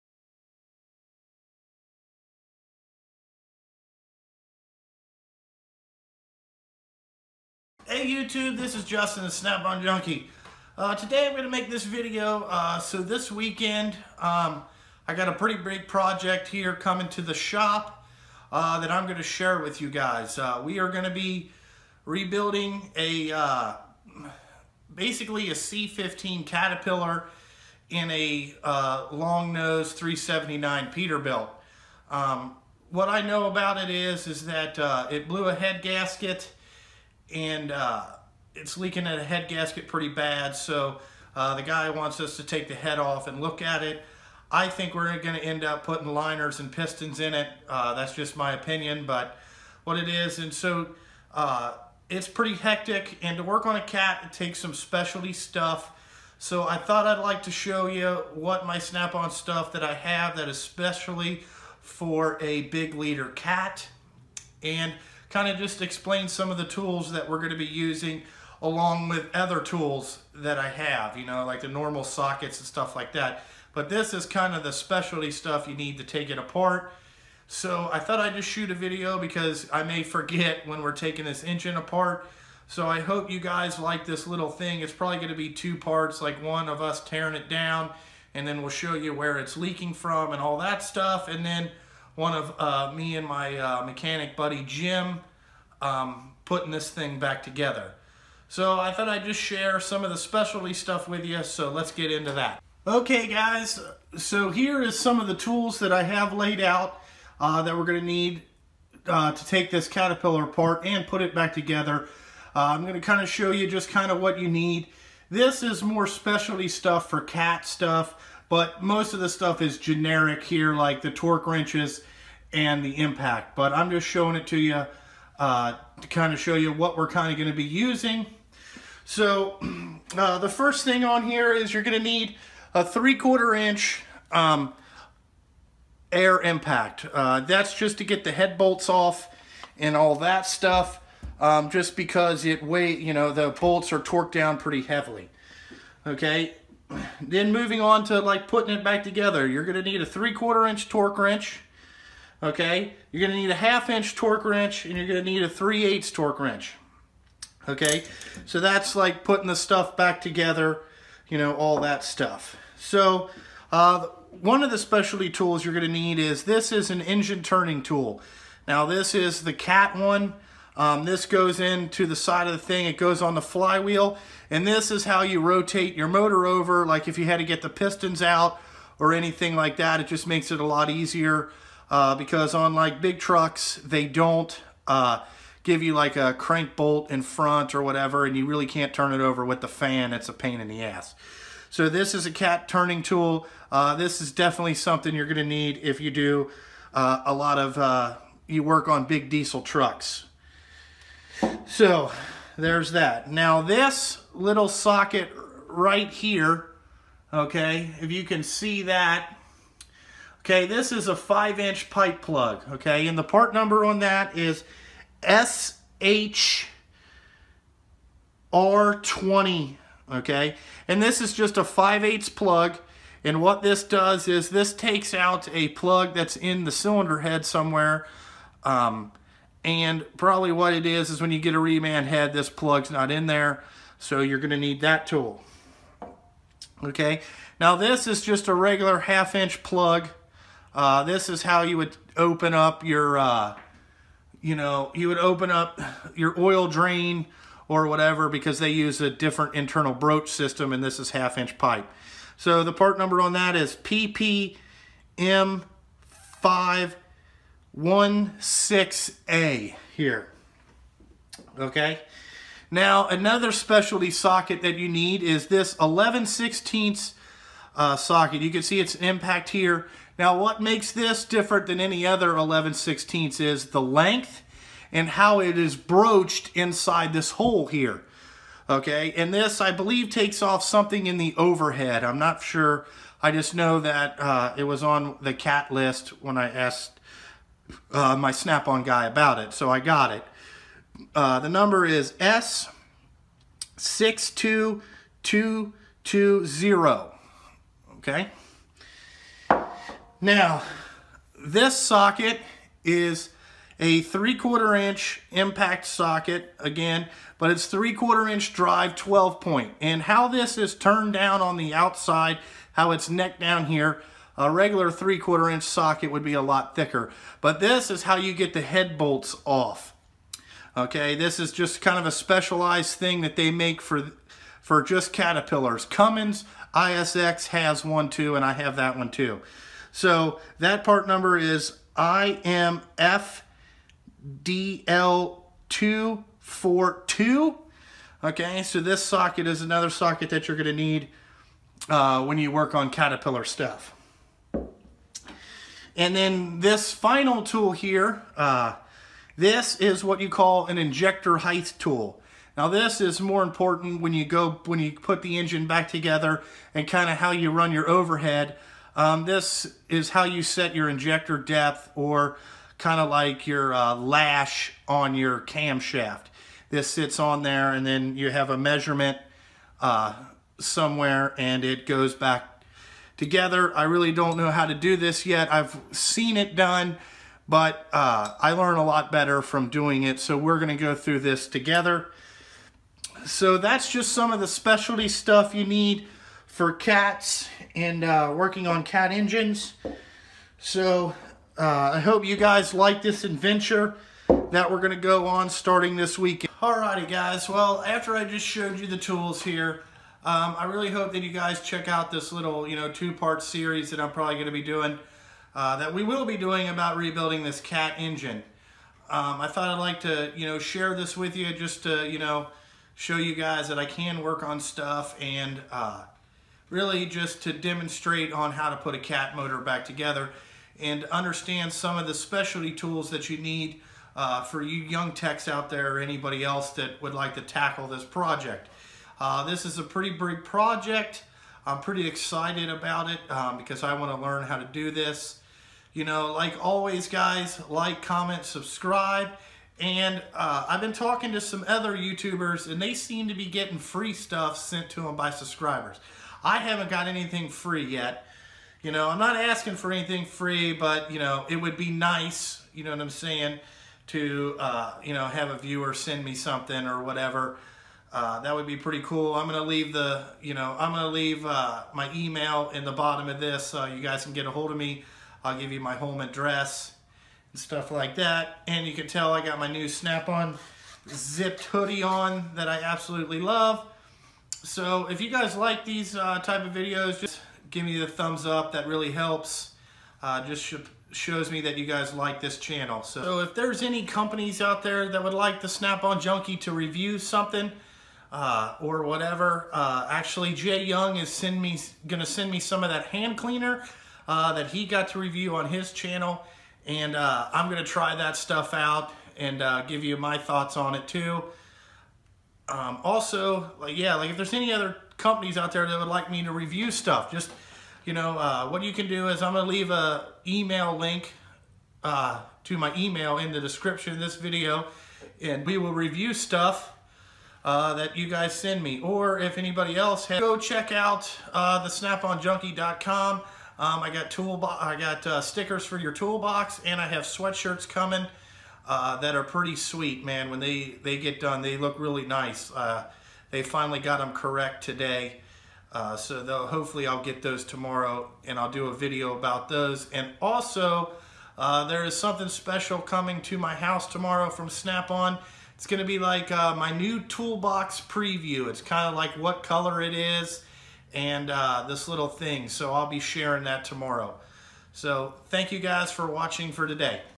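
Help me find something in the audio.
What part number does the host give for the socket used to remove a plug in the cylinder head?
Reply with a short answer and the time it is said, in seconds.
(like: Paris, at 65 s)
SHR20, at 215 s.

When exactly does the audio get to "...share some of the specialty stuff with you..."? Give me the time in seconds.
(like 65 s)
99 s.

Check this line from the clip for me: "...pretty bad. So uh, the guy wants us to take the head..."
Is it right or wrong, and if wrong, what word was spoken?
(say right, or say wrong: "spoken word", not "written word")
right.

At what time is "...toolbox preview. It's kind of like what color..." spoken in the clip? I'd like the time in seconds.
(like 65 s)
547 s.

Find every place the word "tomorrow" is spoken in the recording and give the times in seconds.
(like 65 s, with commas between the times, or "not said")
537 s, 544 s, 553 s.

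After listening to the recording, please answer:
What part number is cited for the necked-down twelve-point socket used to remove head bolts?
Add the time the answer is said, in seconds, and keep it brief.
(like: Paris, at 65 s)
IMFDL242, at 331 s.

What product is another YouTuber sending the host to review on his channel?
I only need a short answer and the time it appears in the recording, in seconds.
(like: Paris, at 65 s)
hand cleaner, at 493 s.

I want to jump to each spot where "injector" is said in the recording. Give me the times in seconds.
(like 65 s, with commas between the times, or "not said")
350 s, 360 s.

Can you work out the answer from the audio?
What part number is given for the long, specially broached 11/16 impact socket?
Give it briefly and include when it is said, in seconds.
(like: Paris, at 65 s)
S62220, at 292 s.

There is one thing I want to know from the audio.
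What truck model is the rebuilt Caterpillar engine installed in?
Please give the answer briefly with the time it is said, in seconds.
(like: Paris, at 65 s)
379 Peterbilt, at 29 s.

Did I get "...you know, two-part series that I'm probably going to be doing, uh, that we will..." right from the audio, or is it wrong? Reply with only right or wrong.
right.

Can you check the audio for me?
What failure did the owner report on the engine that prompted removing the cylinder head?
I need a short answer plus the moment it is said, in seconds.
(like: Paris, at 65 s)
blew a head gasket, at 35 s.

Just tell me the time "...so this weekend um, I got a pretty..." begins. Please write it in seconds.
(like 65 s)
12 s.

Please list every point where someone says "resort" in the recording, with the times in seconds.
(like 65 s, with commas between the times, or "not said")
not said.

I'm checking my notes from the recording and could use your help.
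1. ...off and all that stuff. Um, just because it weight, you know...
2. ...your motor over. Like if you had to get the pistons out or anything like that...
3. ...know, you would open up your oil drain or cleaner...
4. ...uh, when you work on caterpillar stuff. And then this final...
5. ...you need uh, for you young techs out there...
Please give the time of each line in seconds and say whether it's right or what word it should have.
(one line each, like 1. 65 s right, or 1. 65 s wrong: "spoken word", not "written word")
1. 138 s right
2. 175 s right
3. 244 s wrong: "whatever", not "cleaner"
4. 341 s right
5. 423 s right.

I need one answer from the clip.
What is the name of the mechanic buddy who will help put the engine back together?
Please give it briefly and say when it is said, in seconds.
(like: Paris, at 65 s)
Jim, at 94 s.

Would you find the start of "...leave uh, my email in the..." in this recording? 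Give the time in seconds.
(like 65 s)
461 s.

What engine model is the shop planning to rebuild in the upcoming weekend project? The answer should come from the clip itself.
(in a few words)
C-15 Caterpillar.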